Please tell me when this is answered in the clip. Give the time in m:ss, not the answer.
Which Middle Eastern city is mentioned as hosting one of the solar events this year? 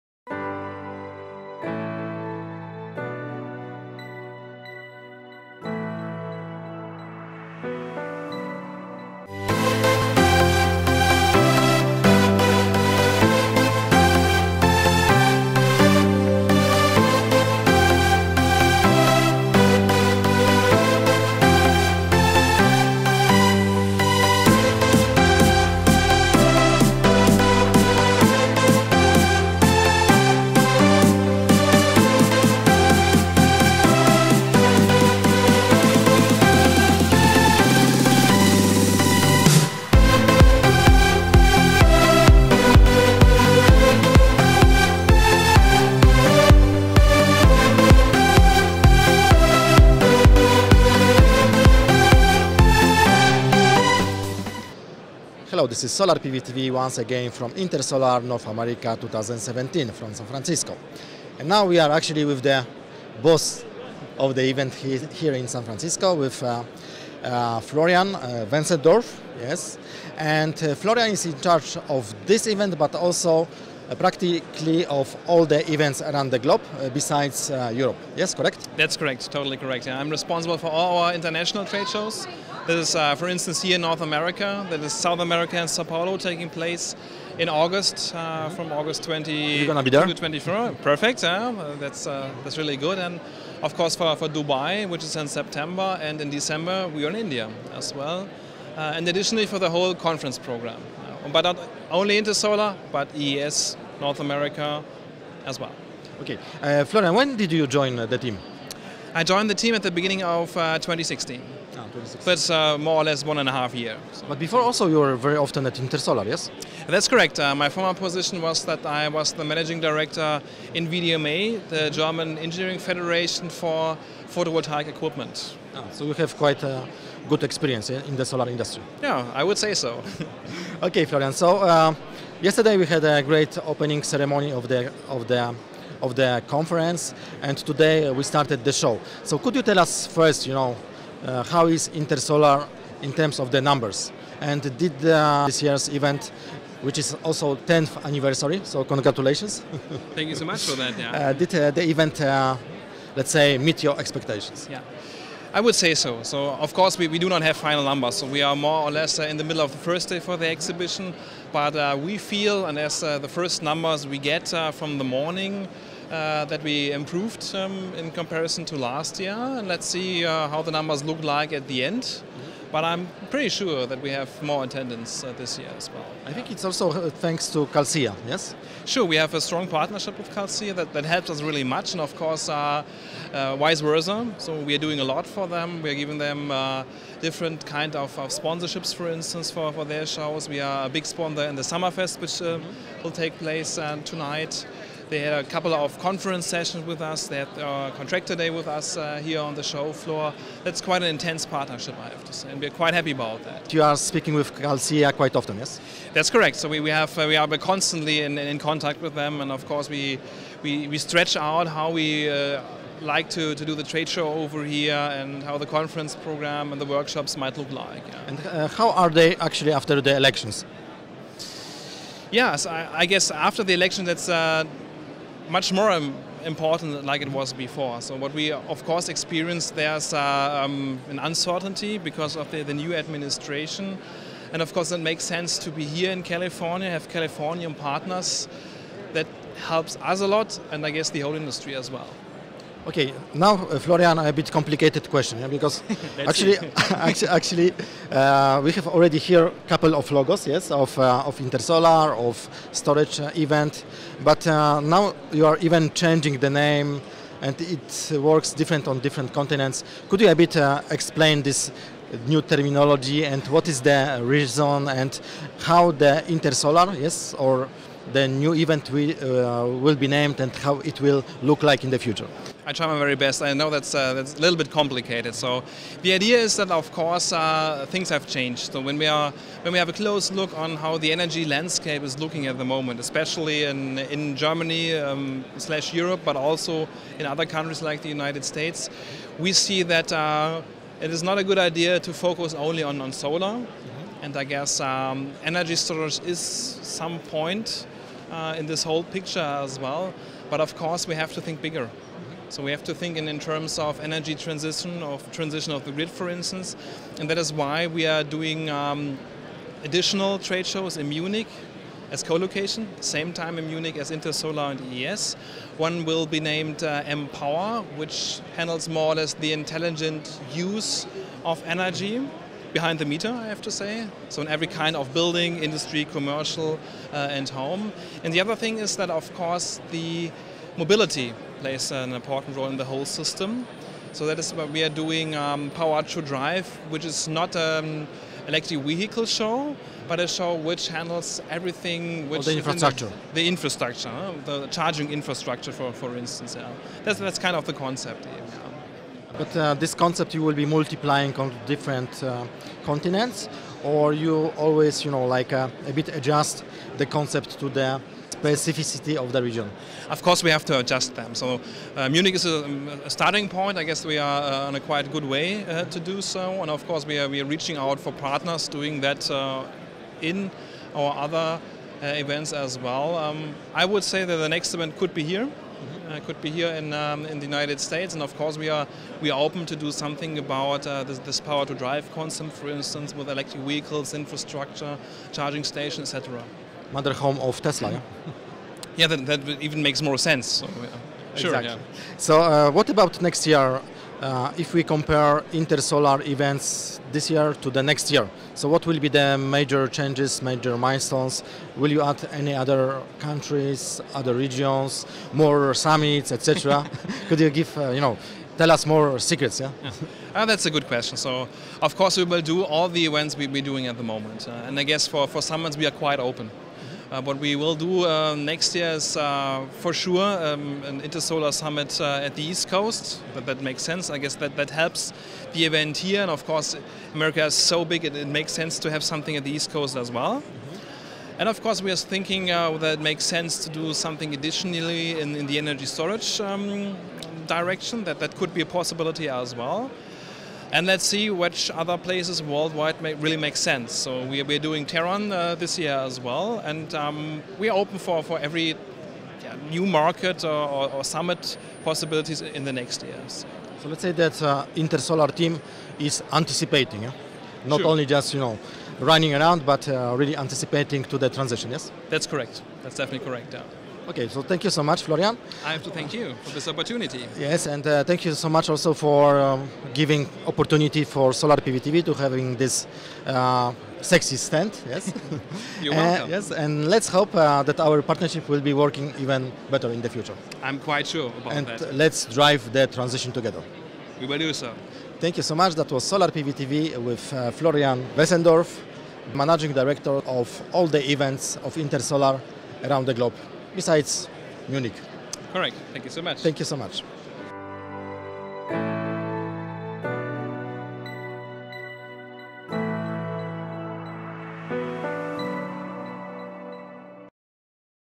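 7:24.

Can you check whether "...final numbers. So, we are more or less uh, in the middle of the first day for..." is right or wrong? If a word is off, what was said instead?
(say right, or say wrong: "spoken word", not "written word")
right.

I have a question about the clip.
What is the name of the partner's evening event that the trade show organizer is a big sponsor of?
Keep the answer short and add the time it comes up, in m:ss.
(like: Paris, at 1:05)
Summerfest, at 3:11.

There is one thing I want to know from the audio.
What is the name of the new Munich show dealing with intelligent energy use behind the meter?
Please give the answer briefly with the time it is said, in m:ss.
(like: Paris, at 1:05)
EM-Power, at 5:17.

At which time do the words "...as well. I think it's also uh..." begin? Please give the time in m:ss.
2:55.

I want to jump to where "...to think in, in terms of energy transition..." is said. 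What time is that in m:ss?
5:02.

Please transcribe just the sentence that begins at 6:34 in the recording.
Uh, if we compare intersolar events this year to the next year, so what will be the major changes, major milestones?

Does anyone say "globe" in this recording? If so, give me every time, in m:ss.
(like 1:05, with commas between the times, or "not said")
1:16, 8:13.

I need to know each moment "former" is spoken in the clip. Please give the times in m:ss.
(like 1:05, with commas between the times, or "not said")
1:57.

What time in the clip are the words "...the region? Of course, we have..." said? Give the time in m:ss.
5:59.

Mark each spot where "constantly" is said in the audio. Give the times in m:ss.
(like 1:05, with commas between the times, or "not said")
3:27.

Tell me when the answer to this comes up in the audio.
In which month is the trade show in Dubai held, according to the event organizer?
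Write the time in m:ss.
1:35.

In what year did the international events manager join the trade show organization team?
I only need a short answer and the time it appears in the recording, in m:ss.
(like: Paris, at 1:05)
2016, at 1:49.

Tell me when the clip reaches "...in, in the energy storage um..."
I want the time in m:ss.
7:15.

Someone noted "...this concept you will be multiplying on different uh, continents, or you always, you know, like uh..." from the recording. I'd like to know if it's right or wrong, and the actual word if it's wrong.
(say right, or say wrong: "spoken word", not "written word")
right.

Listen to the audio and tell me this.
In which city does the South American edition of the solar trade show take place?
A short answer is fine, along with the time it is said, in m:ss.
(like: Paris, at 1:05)
Sao Paulo, at 1:25.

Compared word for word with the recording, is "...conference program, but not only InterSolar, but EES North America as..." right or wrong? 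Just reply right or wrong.
right.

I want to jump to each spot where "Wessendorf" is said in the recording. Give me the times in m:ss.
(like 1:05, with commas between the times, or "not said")
1:08, 8:08.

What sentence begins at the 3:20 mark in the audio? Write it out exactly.
That's quite an intense partnership, I have to say, and we're quite happy about that.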